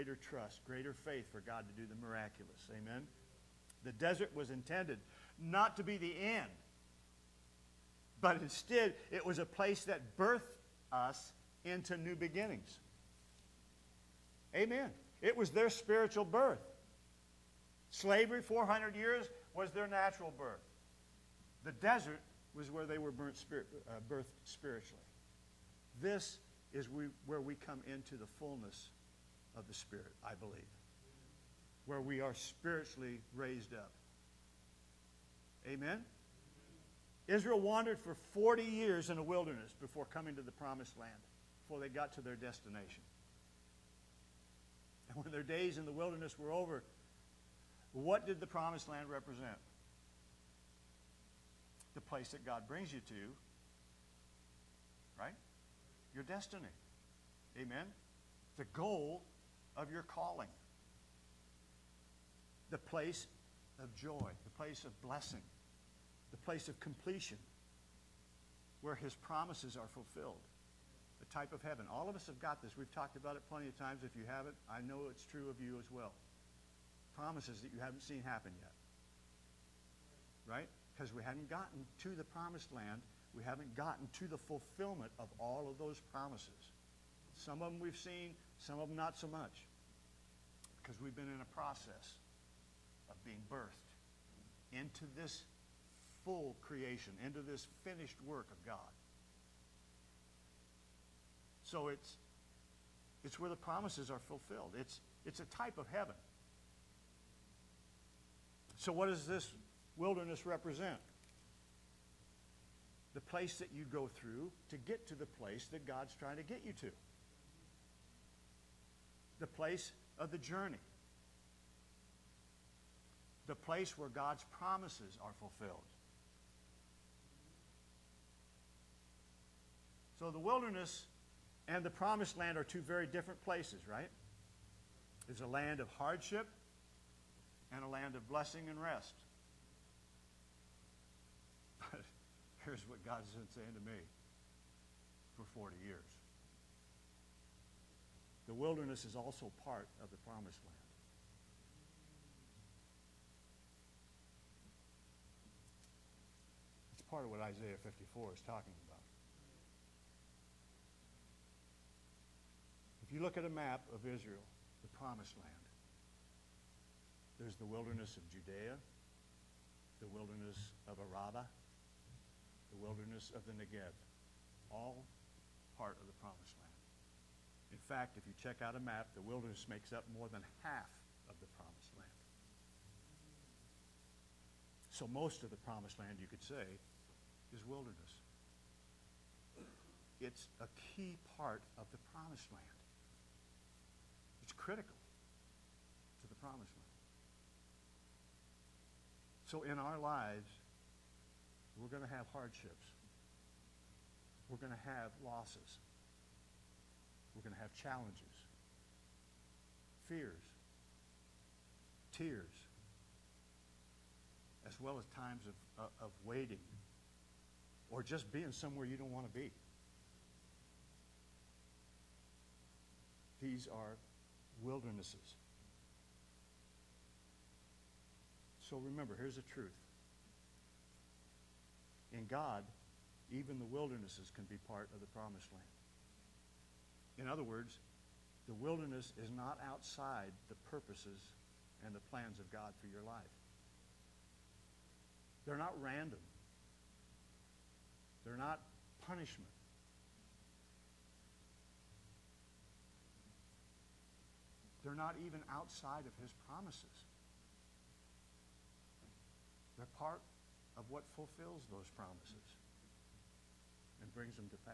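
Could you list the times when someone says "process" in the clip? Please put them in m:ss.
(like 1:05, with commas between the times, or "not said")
1:31.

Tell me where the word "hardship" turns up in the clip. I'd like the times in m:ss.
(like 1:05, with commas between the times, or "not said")
2:15, 3:22.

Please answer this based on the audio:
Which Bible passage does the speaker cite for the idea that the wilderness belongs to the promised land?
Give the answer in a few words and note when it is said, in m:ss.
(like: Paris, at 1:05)
Isaiah 54, at 2:37.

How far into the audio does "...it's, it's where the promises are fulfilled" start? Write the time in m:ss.
1:41.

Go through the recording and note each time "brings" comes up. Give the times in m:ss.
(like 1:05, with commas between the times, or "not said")
0:52, 4:24.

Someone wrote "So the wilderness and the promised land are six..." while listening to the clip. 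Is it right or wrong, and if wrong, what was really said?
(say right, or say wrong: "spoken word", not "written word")
wrong: "two", not "six".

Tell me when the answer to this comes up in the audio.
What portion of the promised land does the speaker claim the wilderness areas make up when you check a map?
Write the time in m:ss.
3:00.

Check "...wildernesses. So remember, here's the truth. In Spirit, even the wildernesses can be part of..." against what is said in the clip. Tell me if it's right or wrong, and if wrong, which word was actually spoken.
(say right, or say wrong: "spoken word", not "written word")
wrong: "God", not "Spirit".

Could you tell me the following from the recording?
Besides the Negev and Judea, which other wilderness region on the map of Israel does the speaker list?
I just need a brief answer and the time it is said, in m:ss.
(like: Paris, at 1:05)
Araba, at 2:50.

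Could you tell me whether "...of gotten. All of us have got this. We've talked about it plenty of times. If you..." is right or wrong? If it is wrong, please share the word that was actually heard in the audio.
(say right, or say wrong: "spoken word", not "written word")
wrong: "heaven", not "gotten".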